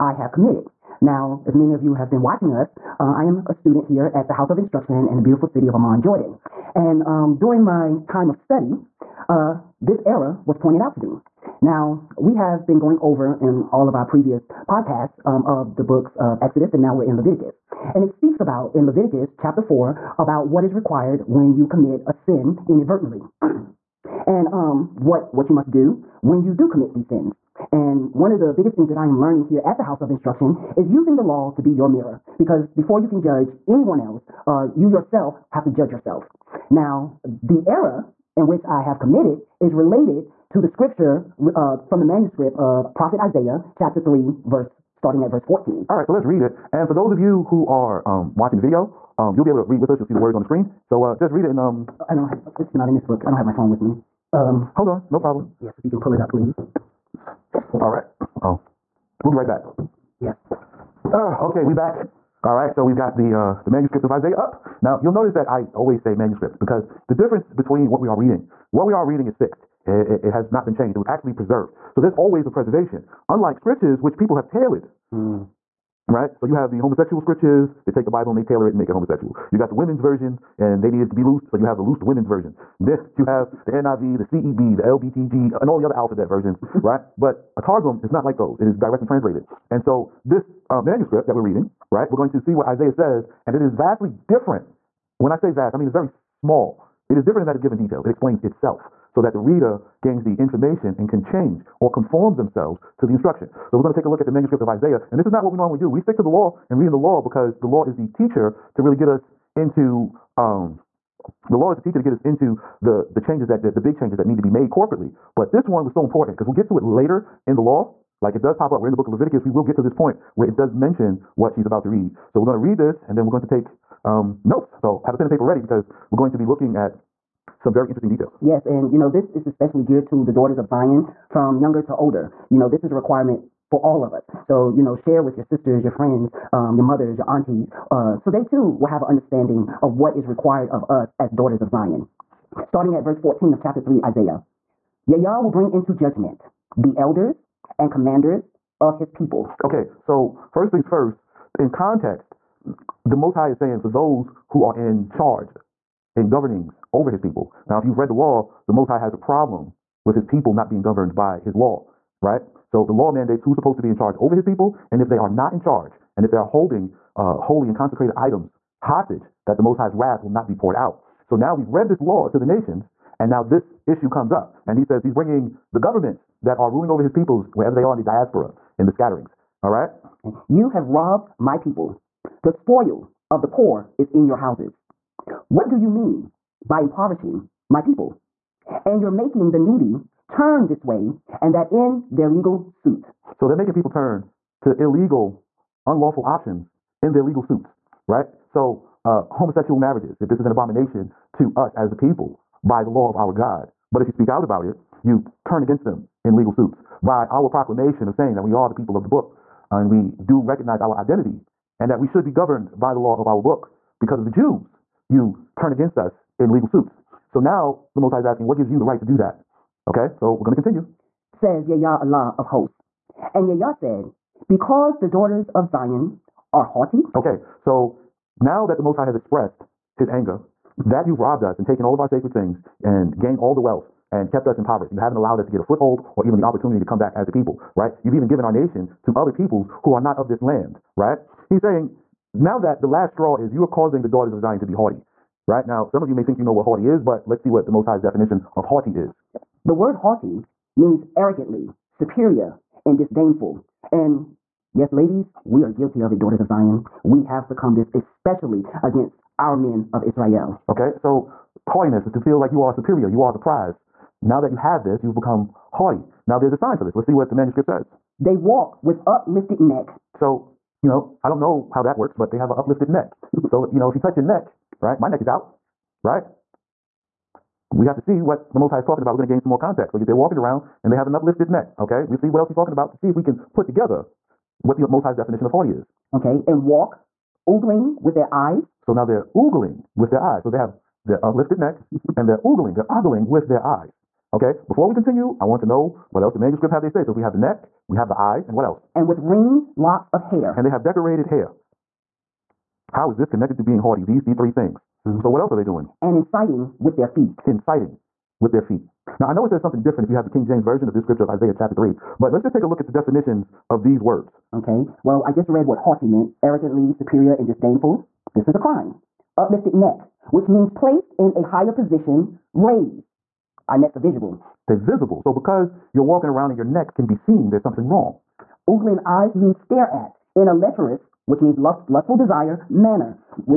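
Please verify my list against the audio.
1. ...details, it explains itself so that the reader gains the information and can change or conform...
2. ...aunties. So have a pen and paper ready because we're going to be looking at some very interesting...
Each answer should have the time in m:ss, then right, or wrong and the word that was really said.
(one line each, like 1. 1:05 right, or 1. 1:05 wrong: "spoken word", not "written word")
1. 1:37 right
2. 2:04 wrong: "notes", not "aunties".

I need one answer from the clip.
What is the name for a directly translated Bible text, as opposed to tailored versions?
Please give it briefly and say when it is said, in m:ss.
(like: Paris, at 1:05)
Targum, at 1:27.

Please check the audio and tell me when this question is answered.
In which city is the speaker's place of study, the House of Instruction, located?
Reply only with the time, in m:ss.
0:05.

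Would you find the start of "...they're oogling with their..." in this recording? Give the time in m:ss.
4:49.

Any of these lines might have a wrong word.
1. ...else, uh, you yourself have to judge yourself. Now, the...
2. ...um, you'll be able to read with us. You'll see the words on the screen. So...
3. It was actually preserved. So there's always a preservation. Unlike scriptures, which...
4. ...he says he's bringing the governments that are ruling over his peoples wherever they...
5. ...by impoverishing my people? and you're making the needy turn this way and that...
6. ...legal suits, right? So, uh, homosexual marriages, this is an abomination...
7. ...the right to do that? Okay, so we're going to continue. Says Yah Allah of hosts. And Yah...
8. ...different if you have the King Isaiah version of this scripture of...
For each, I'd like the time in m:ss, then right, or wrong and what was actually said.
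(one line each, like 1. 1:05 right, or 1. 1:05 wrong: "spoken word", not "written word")
1. 0:33 right
2. 0:49 right
3. 1:10 right
4. 2:54 right
5. 3:06 right
6. 3:17 right
7. 3:38 right
8. 5:09 wrong: "James", not "Isaiah".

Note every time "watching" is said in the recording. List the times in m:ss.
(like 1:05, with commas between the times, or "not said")
0:02, 0:48.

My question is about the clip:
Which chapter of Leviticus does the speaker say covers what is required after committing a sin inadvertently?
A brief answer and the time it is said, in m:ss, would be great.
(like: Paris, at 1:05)
Chapter 4, at 0:19.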